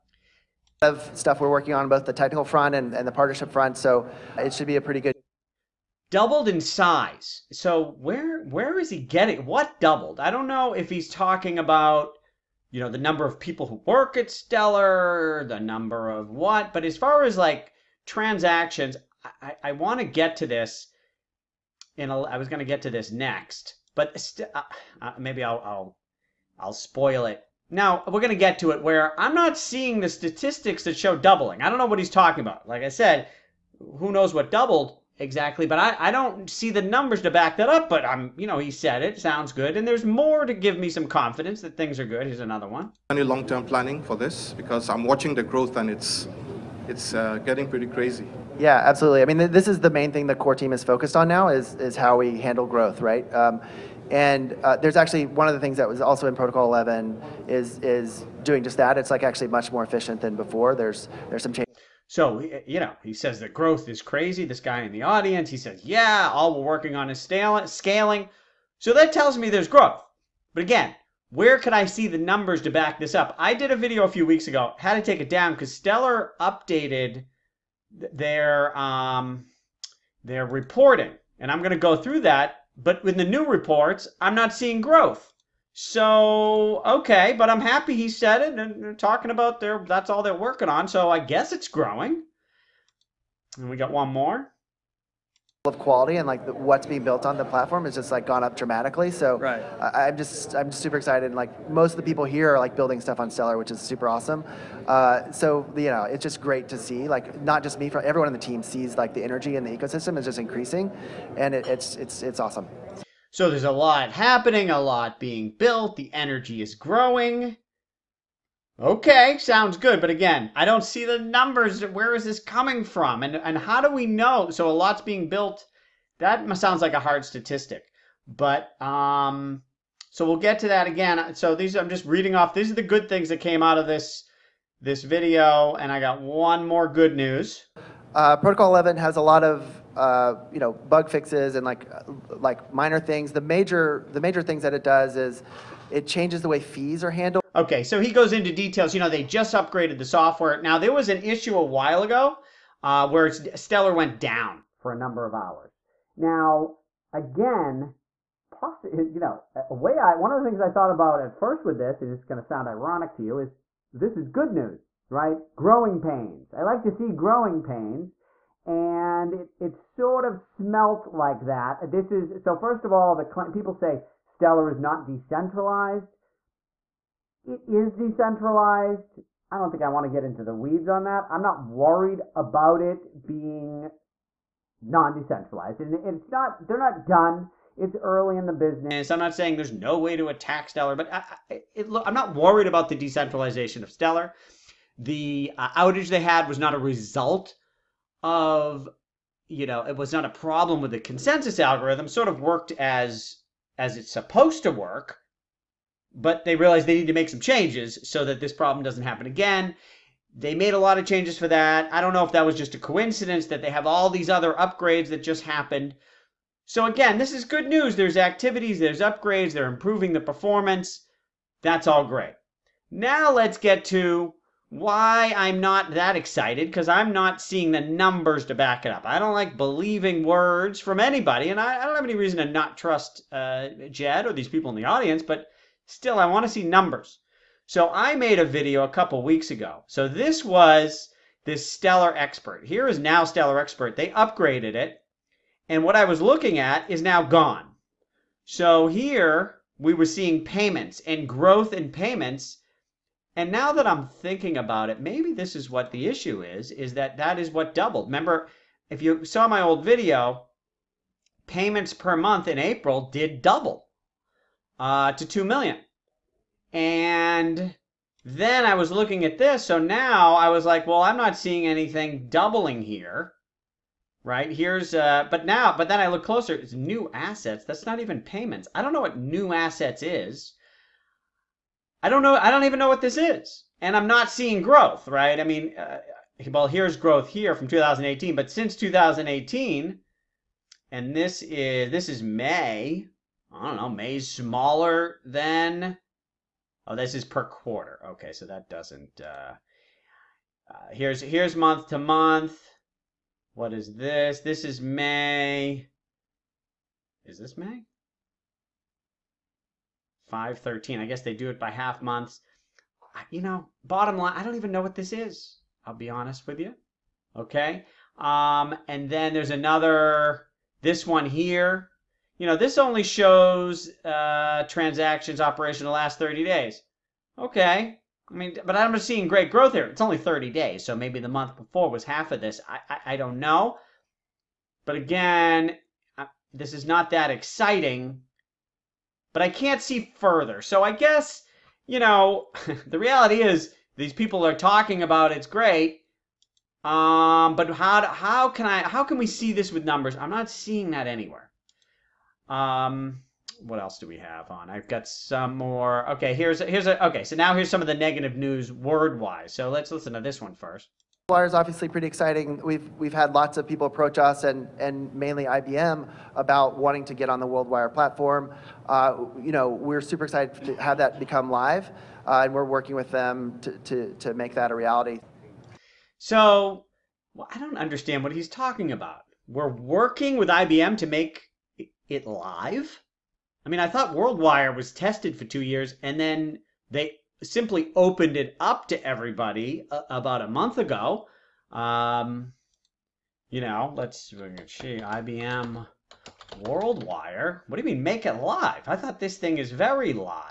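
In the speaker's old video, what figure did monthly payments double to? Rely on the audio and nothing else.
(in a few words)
2 million.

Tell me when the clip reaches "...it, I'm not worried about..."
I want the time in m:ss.
3:11.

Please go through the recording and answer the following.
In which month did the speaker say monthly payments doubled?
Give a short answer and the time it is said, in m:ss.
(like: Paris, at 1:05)
April, at 4:22.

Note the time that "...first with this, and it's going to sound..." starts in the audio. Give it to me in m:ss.
2:41.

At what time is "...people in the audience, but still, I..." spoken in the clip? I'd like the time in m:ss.
3:54.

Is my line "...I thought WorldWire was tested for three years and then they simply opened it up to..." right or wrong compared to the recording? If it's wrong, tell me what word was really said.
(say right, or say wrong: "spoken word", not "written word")
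wrong: "two", not "three".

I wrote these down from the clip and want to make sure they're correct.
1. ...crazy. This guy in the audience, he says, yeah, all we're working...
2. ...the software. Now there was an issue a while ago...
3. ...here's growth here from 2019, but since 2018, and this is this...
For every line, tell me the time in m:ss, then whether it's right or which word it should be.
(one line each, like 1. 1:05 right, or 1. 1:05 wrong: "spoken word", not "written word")
1. 1:04 right
2. 2:29 right
3. 4:46 wrong: "2018", not "2019".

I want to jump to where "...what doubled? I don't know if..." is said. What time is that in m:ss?
0:09.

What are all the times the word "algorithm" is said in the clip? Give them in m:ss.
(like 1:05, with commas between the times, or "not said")
3:21.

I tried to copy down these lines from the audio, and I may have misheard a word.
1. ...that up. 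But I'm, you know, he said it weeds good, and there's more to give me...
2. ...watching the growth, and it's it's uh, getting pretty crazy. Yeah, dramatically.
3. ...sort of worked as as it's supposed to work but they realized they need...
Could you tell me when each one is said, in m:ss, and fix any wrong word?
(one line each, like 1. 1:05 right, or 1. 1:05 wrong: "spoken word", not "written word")
1. 0:37 wrong: "sounds", not "weeds"
2. 0:45 wrong: "absolutely", not "dramatically"
3. 3:22 right.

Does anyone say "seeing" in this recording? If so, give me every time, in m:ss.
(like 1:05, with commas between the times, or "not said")
0:29, 1:24, 3:47, 4:10, 4:31, 4:44, 5:29, 5:50.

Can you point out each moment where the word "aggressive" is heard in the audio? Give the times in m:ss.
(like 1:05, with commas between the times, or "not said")
not said.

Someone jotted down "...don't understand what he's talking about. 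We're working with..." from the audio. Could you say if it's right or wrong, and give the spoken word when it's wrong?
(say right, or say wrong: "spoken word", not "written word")
right.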